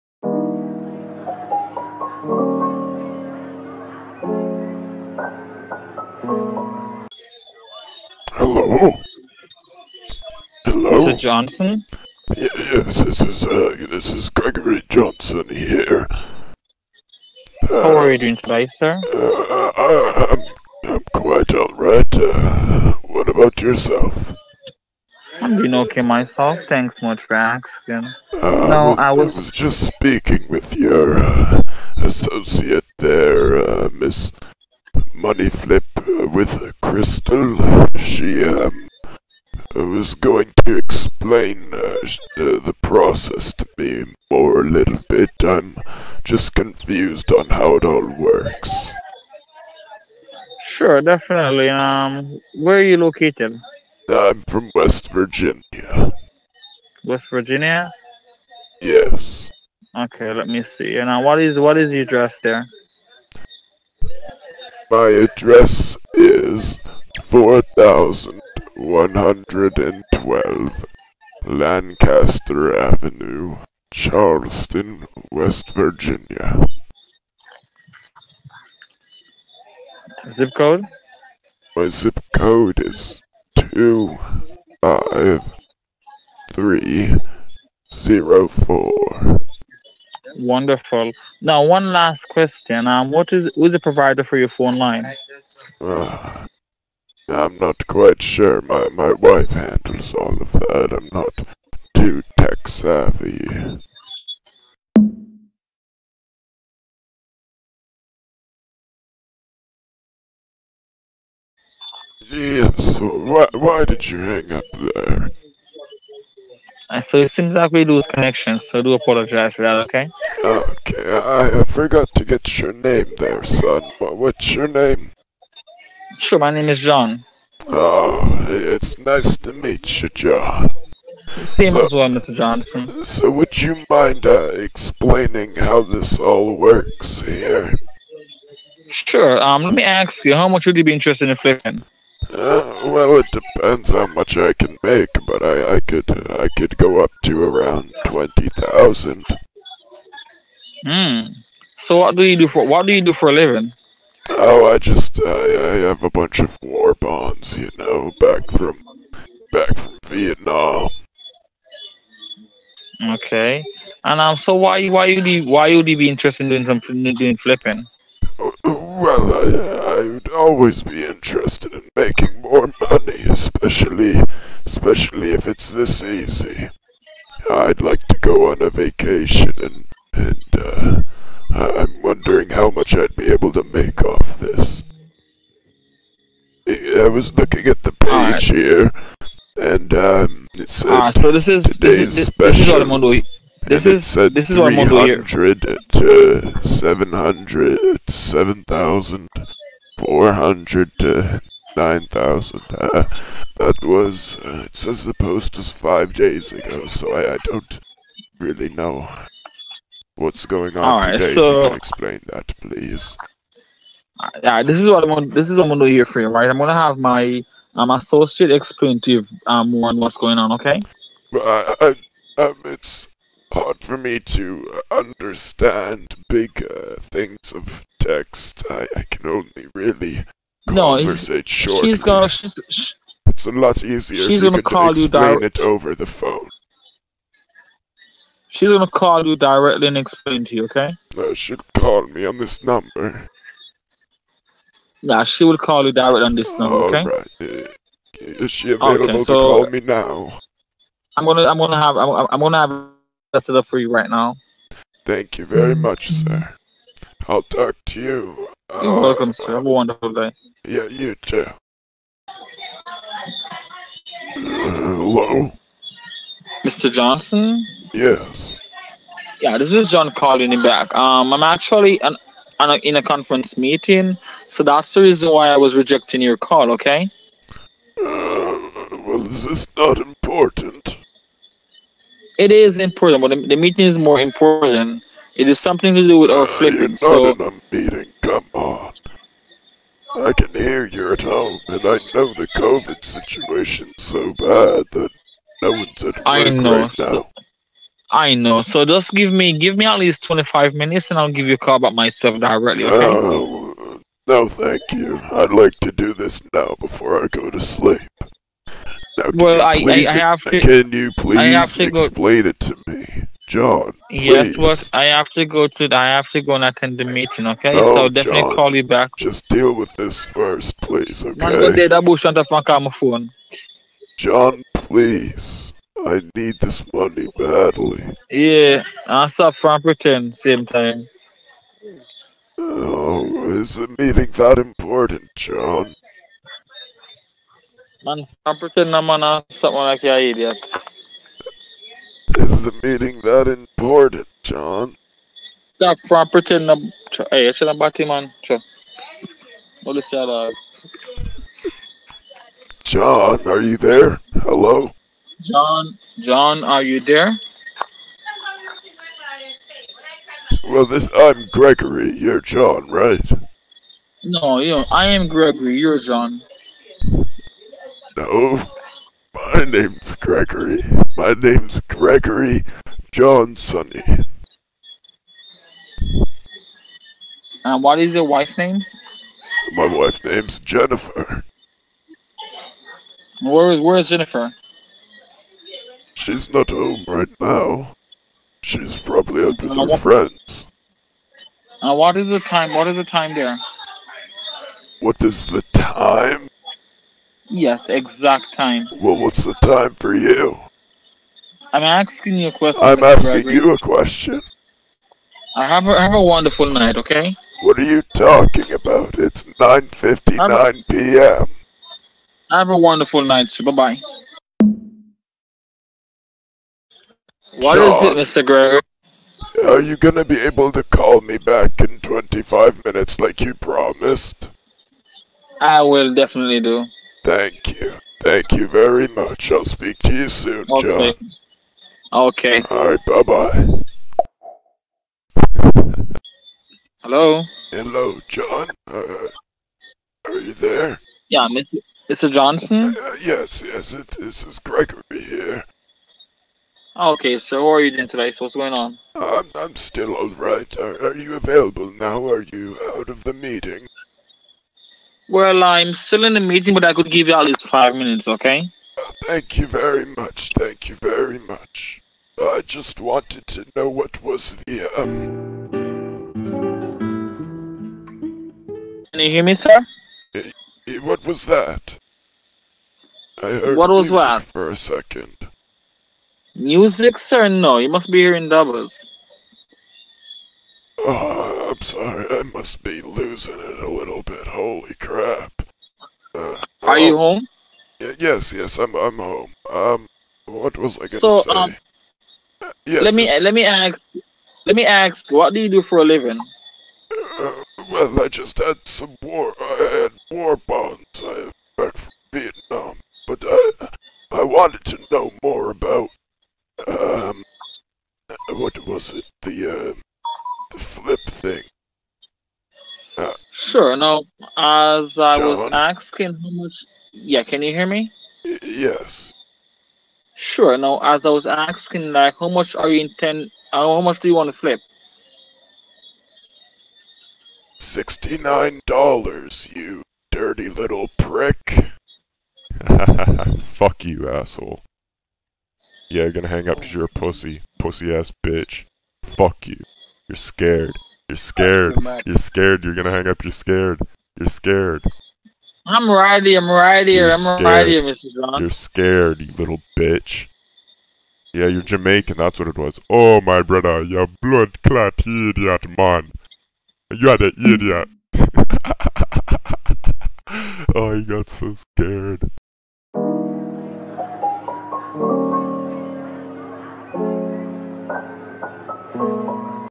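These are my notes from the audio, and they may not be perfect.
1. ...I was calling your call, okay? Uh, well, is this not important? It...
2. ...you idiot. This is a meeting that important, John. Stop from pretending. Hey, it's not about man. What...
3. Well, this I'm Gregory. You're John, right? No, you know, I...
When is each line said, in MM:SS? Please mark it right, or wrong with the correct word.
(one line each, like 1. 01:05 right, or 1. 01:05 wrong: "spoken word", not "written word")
1. 04:35 wrong: "rejecting", not "calling"
2. 05:40 right
3. 06:00 right.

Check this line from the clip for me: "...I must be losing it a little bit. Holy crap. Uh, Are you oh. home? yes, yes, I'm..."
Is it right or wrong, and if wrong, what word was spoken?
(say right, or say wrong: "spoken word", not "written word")
right.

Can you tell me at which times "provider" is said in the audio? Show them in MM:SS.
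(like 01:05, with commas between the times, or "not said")
01:33.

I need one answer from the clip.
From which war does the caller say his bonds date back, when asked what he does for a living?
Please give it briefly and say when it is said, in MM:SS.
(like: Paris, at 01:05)
Vietnam, at 02:40.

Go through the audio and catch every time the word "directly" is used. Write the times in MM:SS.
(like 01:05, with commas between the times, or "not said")
03:59, 04:05, 05:02.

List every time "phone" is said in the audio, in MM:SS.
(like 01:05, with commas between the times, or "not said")
01:34, 03:56.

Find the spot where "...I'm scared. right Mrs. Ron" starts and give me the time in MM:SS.
09:07.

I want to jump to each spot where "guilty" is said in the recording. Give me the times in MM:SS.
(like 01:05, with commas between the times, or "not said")
not said.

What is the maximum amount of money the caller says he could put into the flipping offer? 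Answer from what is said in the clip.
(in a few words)
20,000.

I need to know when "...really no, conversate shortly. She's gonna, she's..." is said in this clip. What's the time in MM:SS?
03:49.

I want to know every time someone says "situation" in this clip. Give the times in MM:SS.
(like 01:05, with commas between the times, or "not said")
04:53.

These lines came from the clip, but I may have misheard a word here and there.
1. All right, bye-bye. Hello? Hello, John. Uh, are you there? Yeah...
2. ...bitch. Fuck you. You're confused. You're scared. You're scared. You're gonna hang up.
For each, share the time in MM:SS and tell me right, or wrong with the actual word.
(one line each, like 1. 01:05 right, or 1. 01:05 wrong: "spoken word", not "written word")
1. 07:12 right
2. 08:58 wrong: "scared", not "confused".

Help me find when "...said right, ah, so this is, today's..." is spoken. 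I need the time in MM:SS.
03:10.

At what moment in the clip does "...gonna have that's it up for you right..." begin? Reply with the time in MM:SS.
04:12.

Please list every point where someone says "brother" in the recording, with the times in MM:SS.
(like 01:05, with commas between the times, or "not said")
09:13.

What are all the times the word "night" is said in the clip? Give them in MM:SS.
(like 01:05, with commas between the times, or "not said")
06:46, 06:53.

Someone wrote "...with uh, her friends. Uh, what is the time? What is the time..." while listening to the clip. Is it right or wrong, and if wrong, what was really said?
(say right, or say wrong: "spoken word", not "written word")
right.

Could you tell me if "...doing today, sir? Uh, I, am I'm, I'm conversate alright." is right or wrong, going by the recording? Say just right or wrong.
wrong.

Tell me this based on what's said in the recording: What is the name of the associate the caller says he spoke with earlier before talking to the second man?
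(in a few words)
Miss Moneyflip.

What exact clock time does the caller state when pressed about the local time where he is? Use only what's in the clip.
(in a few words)
9:59 p.m.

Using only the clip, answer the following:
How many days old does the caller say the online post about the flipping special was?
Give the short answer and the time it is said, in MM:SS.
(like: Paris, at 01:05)
5 days, at 03:25.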